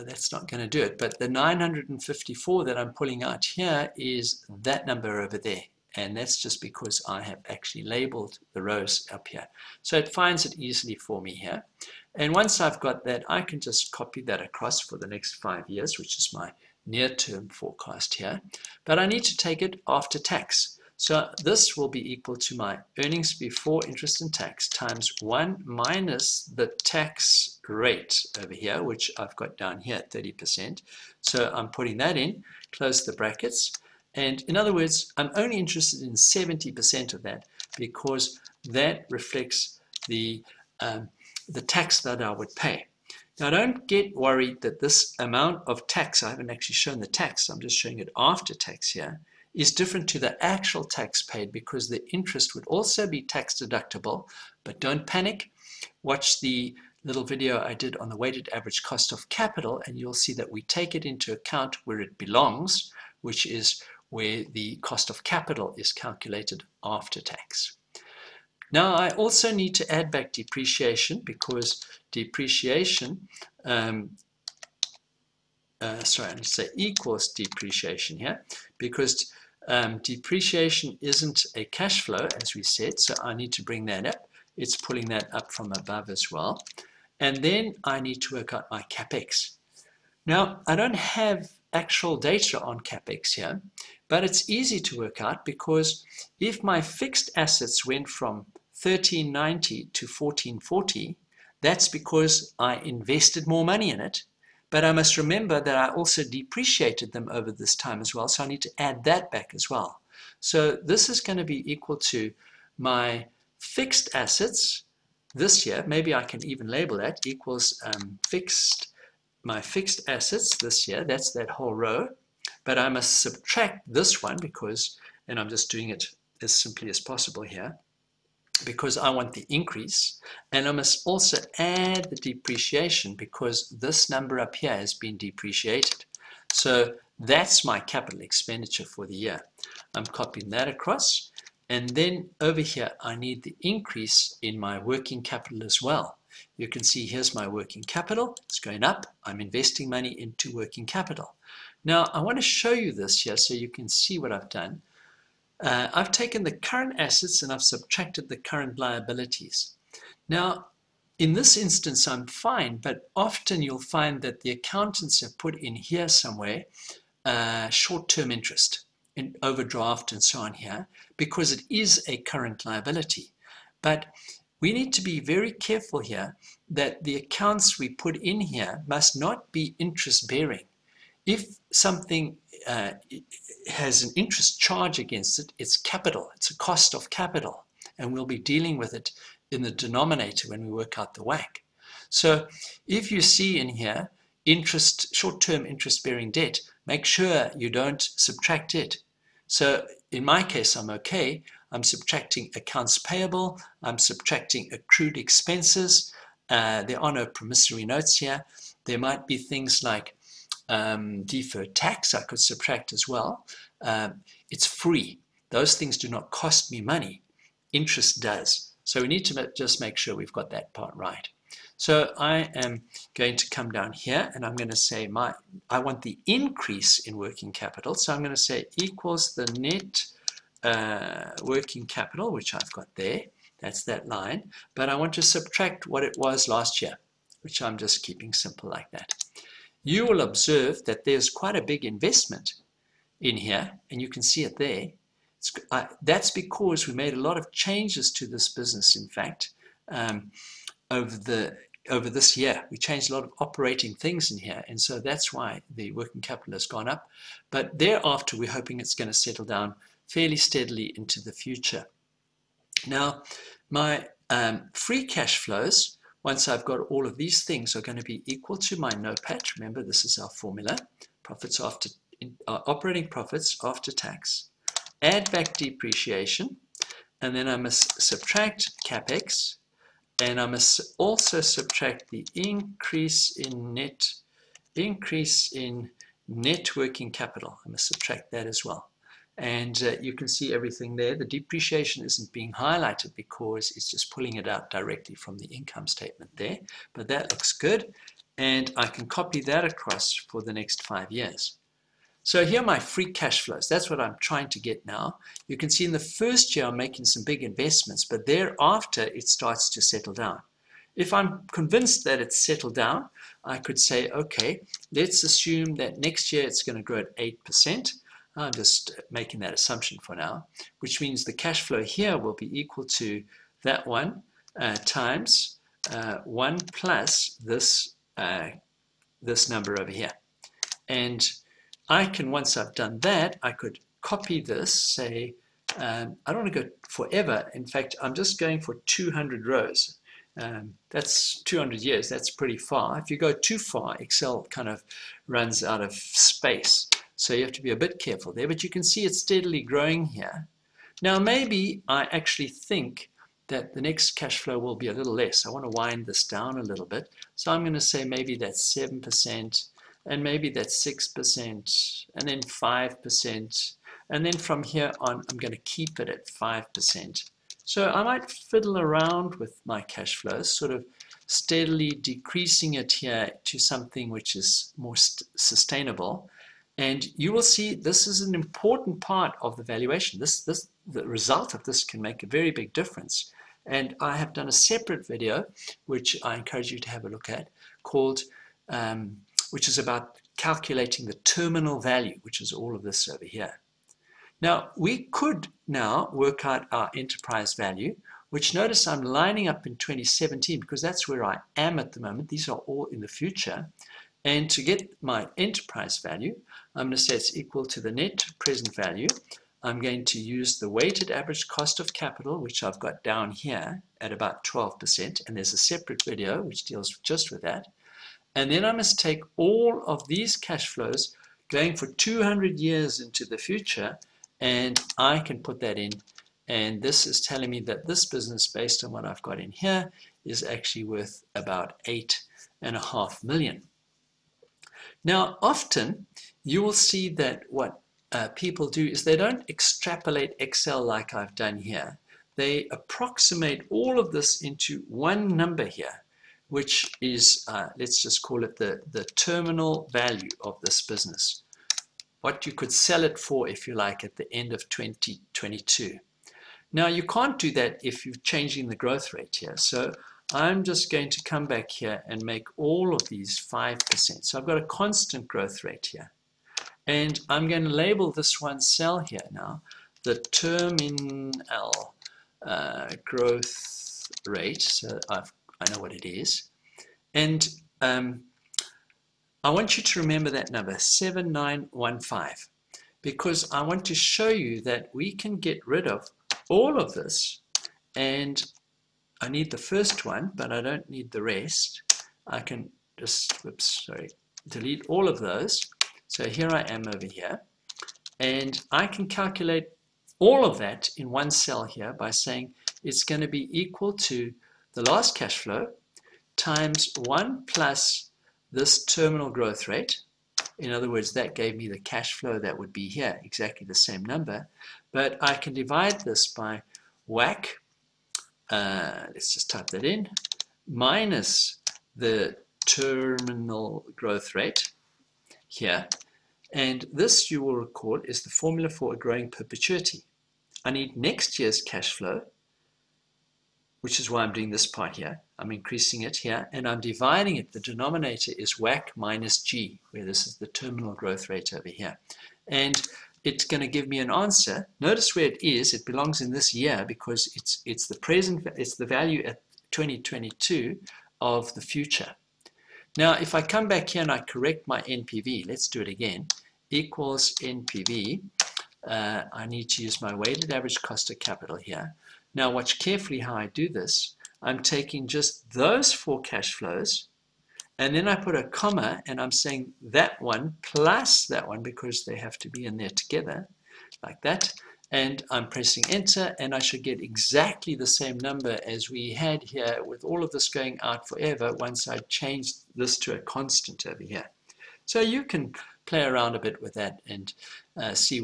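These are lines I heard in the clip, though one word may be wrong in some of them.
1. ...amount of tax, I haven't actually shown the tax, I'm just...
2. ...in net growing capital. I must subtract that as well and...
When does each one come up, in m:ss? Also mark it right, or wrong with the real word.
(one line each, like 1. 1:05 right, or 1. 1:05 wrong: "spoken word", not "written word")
1. 0:45 right
2. 4:45 wrong: "working", not "growing".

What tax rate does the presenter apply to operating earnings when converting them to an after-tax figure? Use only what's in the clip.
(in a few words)
30%.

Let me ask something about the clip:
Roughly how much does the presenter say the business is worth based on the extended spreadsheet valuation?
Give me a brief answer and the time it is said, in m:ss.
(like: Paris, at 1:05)
8.5 million, at 7:11.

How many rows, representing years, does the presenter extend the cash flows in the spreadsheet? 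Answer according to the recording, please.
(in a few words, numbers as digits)
200.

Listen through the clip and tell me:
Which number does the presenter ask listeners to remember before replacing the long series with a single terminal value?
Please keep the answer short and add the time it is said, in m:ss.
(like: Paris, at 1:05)
7915, at 8:00.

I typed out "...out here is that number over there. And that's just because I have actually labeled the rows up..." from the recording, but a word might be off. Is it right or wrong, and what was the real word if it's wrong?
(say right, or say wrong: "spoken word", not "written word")
right.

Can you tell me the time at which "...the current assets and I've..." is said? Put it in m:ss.
2:36.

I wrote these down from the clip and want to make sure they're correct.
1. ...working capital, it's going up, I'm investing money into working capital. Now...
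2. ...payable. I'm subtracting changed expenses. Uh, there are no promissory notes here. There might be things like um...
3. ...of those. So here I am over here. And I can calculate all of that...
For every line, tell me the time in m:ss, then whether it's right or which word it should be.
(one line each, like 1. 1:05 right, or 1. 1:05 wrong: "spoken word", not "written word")
1. 2:27 right
2. 3:22 wrong: "accrued", not "changed"
3. 8:15 right.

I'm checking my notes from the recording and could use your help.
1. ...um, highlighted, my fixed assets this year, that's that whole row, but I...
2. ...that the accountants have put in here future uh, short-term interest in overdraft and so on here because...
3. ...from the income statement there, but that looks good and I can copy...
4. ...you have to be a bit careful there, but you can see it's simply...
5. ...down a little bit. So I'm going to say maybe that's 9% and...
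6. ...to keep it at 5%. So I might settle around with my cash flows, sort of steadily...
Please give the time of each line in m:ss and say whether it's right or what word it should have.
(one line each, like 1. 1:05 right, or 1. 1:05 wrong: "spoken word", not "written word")
1. 1:57 wrong: "fixed", not "highlighted"
2. 2:44 wrong: "somewhere", not "future"
3. 4:55 right
4. 5:47 wrong: "steadily", not "simply"
5. 5:56 wrong: "7", not "9"
6. 6:05 wrong: "fiddle", not "settle".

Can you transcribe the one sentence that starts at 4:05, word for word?
Uh, that's because we made a lot of changes to this business, in fact, um, over the over this year.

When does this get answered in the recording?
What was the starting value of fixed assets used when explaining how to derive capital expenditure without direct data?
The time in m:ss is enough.
1:38.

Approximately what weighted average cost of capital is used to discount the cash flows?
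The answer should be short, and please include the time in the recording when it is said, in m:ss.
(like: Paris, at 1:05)
12%, at 6:54.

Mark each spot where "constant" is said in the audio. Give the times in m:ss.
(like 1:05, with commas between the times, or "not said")
7:44, 9:43.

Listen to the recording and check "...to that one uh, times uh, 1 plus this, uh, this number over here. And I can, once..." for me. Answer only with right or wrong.
right.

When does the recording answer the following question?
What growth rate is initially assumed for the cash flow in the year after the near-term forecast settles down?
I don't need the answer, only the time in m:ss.
5:17.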